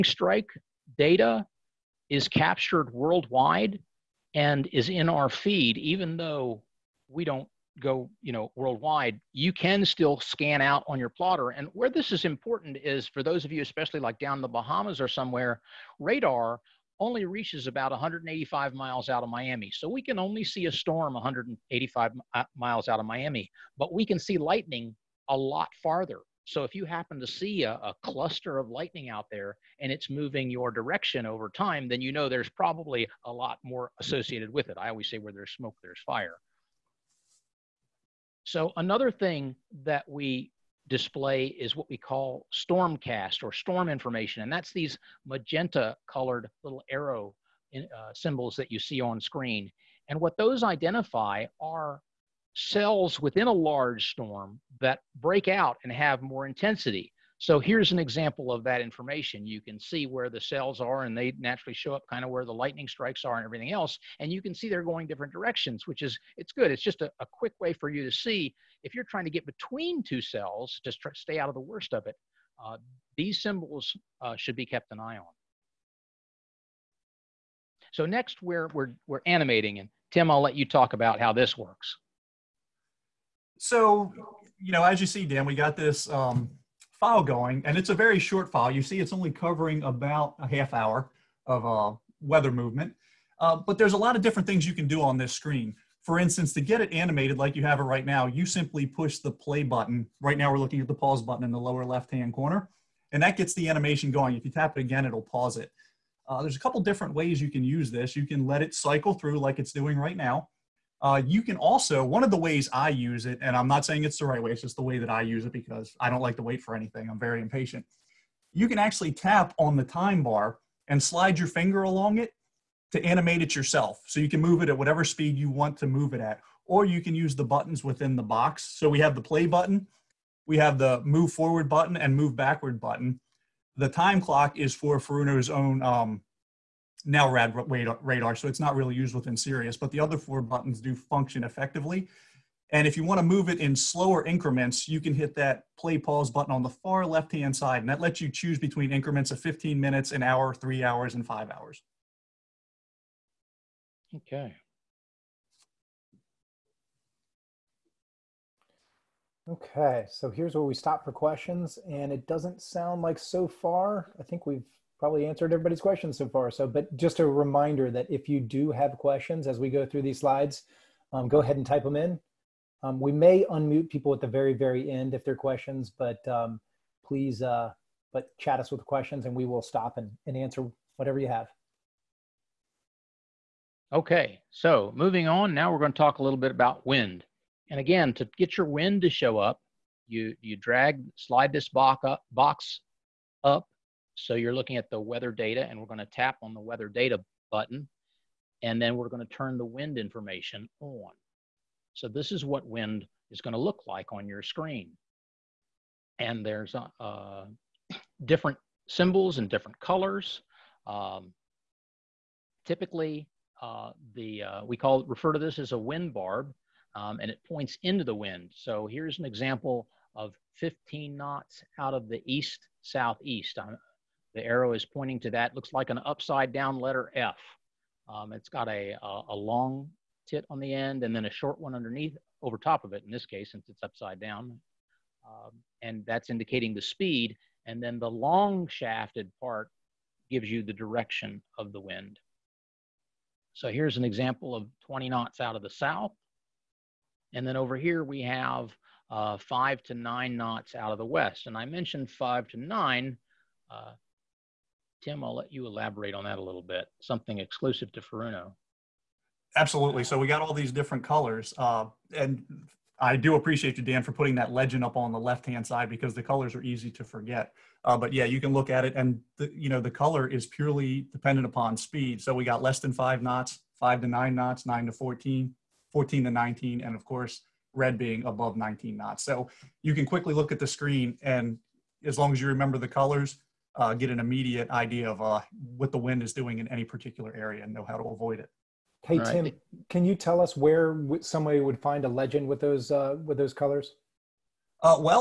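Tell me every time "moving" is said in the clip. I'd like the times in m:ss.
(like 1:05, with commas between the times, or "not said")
0:30, 3:04.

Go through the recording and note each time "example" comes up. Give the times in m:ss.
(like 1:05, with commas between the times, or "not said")
0:57, 3:39, 4:04.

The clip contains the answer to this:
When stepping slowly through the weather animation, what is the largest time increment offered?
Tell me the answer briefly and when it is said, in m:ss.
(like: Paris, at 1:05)
5 hours, at 2:31.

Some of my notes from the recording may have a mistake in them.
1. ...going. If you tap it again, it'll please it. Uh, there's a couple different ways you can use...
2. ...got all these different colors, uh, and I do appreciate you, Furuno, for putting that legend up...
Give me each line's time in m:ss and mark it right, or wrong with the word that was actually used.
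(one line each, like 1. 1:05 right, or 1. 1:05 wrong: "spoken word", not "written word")
1. 1:44 wrong: "pause", not "please"
2. 4:20 wrong: "Dan", not "Furuno".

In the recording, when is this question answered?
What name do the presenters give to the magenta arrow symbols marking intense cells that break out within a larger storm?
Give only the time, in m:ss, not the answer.
0:42.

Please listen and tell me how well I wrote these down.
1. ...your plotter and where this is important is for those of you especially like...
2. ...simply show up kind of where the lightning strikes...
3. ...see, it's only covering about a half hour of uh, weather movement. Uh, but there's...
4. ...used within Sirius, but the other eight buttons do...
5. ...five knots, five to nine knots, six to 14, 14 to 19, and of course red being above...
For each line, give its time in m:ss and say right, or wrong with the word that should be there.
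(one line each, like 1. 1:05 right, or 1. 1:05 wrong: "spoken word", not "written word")
1. 0:10 right
2. 1:01 wrong: "naturally", not "simply"
3. 1:28 right
4. 2:18 wrong: "four", not "eight"
5. 4:32 wrong: "nine", not "six".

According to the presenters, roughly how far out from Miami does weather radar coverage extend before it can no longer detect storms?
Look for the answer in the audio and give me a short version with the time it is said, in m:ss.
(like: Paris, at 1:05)
185 miles, at 0:17.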